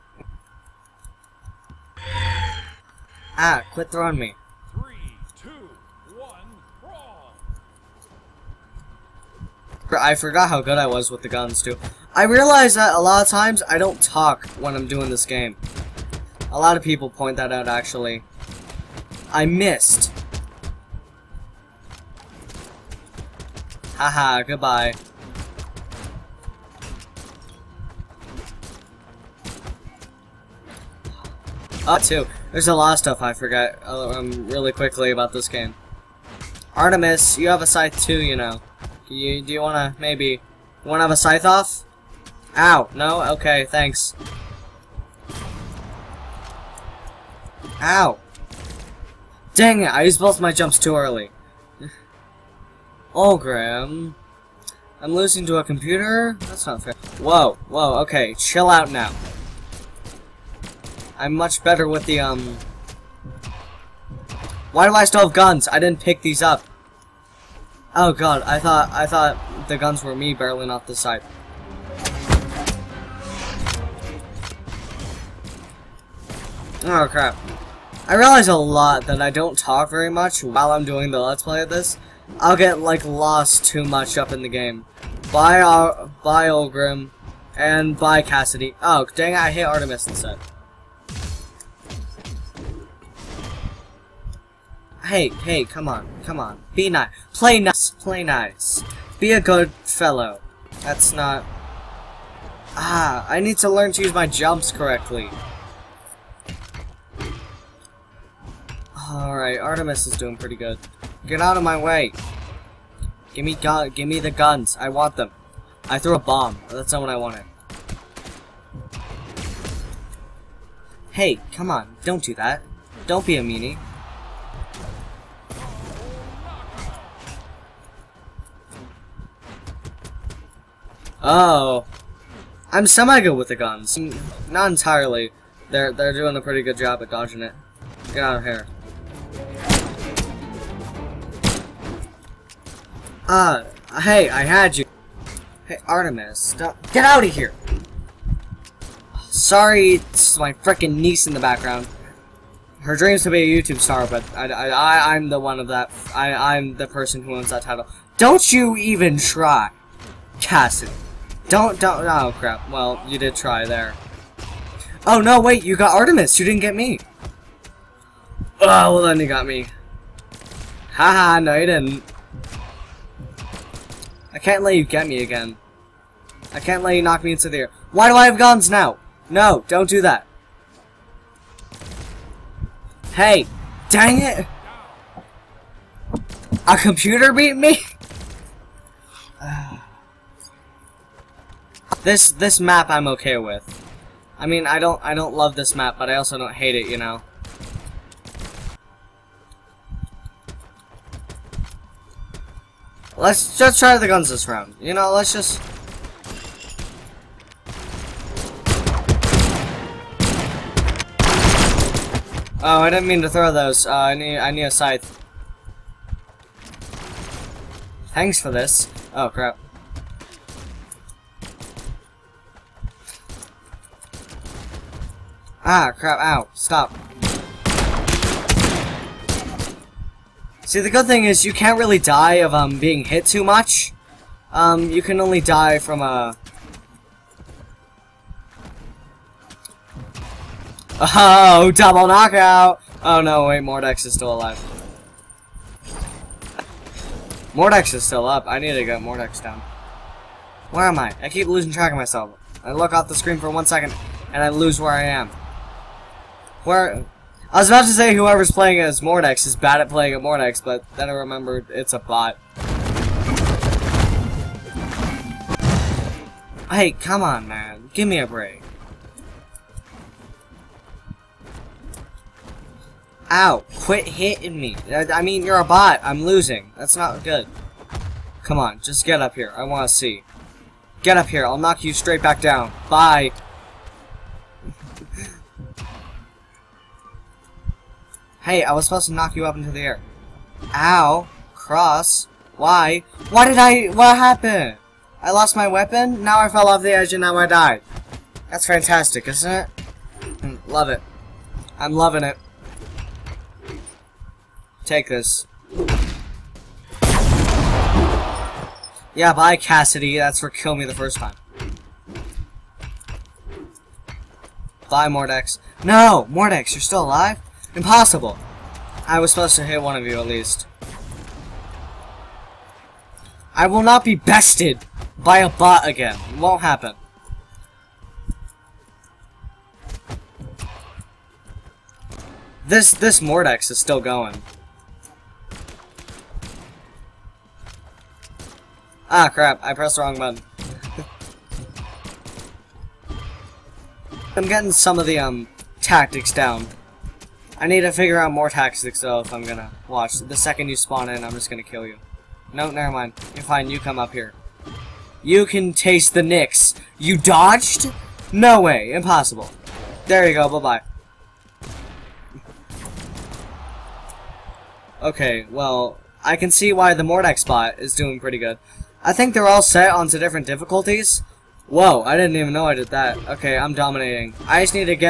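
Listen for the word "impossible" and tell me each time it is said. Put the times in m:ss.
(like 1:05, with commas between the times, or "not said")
5:17, 5:58.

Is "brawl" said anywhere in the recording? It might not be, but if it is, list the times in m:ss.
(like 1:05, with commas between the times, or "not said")
0:06.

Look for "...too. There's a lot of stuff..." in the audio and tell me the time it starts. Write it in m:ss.
0:31.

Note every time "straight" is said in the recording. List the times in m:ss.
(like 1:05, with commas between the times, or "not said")
4:41.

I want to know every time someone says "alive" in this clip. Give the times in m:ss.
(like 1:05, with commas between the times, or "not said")
4:04, 5:17.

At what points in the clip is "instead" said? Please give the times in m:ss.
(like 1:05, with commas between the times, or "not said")
1:30.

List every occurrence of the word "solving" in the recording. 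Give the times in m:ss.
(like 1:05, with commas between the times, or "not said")
not said.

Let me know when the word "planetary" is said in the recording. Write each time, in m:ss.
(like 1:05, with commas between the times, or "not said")
not said.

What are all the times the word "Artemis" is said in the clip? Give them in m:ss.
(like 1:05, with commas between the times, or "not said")
0:36, 1:29, 1:49, 2:25, 2:45.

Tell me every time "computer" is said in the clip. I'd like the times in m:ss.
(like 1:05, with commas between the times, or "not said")
0:55, 3:06.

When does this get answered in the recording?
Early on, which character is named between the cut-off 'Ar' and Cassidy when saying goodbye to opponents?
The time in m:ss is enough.
1:26.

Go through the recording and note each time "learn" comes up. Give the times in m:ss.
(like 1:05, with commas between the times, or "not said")
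1:43.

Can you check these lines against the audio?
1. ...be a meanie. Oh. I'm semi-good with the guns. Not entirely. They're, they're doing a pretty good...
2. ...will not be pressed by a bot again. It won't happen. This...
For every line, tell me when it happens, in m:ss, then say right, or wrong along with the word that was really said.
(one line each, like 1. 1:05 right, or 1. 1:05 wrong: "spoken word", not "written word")
1. 2:03 right
2. 5:23 wrong: "bested", not "pressed".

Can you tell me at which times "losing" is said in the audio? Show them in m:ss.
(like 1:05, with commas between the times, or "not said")
0:55, 4:11, 4:36.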